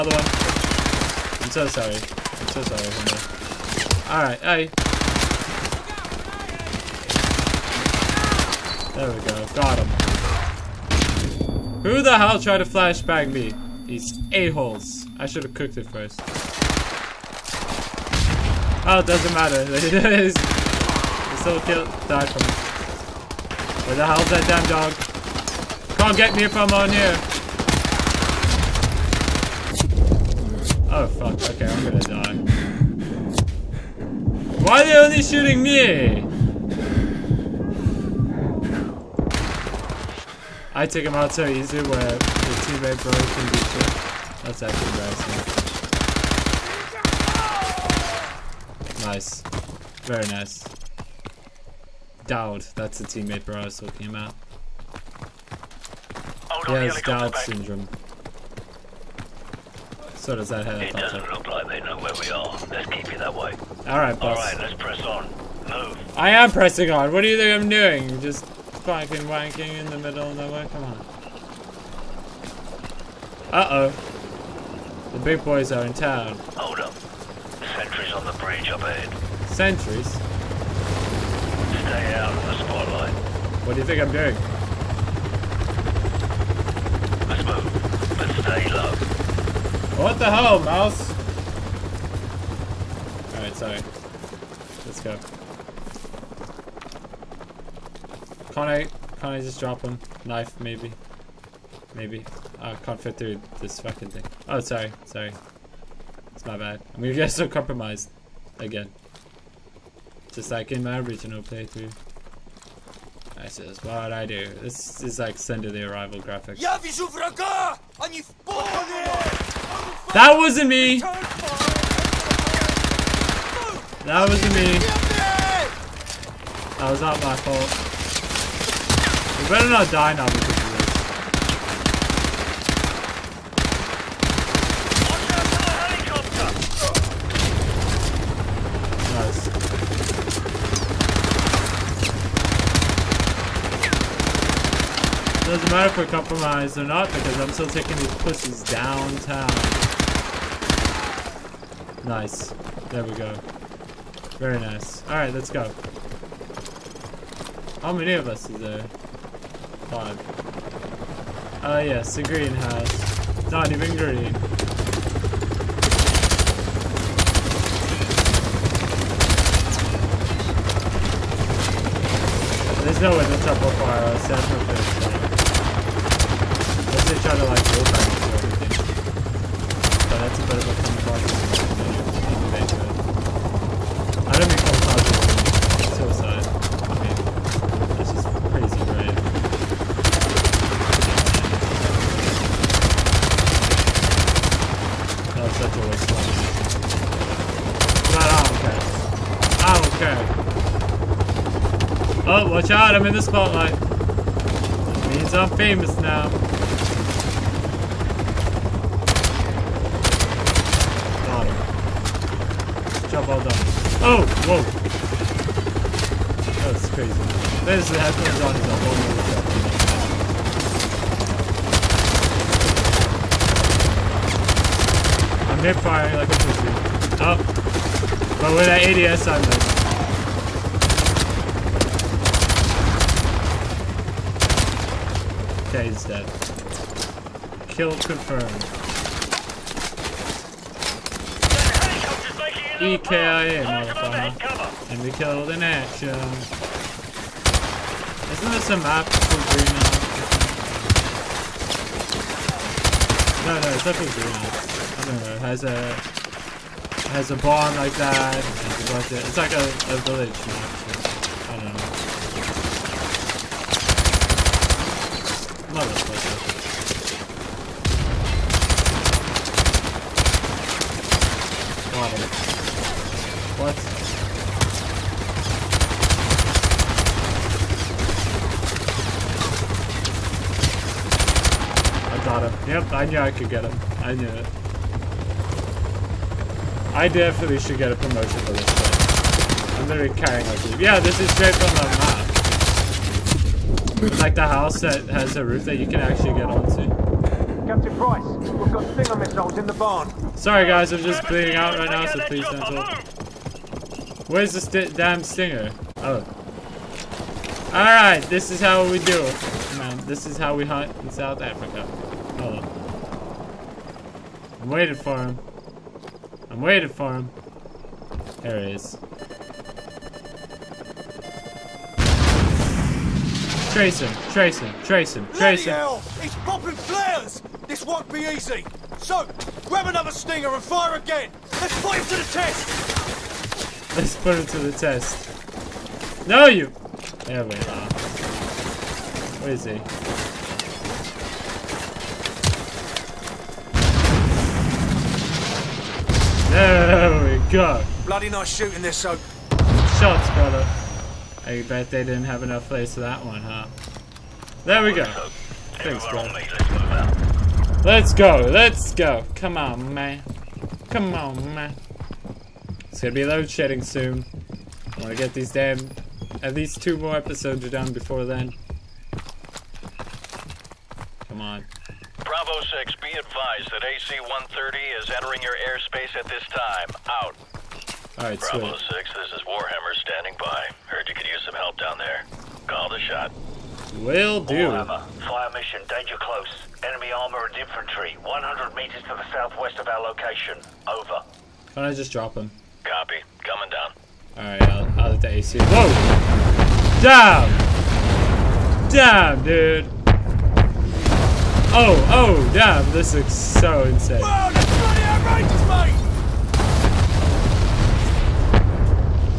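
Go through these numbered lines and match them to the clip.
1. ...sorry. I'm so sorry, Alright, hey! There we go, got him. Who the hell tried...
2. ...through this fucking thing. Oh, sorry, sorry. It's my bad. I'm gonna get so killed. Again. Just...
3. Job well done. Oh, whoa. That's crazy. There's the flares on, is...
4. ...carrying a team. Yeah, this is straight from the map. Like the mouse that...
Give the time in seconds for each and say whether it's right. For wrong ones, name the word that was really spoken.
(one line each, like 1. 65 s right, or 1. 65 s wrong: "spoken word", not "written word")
1. 1 s right
2. 103 s wrong: "compromised", not "killed"
3. 213 s wrong: "headphones", not "flares"
4. 290 s wrong: "house", not "mouse".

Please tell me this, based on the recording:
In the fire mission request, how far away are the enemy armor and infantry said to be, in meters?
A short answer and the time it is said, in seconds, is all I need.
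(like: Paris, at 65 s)
100, at 388 s.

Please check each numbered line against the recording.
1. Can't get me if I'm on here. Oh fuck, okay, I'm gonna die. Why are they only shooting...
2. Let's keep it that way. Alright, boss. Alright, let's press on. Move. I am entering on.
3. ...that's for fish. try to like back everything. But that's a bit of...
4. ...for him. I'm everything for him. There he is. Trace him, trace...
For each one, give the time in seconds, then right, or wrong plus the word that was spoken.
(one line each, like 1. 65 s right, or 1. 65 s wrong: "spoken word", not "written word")
1. 25 s right
2. 62 s wrong: "pressing", not "entering"
3. 174 s right
4. 314 s wrong: "waiting", not "everything".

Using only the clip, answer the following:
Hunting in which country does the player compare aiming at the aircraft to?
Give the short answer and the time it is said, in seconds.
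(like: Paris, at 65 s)
South Africa, at 311 s.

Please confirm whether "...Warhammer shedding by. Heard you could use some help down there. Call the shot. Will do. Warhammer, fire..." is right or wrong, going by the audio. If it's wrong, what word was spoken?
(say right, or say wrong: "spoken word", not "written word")
wrong: "standing", not "shedding".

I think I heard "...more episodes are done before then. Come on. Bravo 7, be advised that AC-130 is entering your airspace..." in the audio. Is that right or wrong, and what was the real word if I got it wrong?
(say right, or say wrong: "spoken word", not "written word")
wrong: "6", not "7".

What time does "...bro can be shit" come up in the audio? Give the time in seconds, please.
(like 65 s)
43 s.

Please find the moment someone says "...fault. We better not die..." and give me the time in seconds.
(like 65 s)
127 s.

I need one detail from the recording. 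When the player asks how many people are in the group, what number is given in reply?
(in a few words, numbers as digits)
5.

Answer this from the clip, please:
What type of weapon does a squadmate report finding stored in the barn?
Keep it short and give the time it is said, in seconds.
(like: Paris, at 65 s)
Stinger missiles, at 298 s.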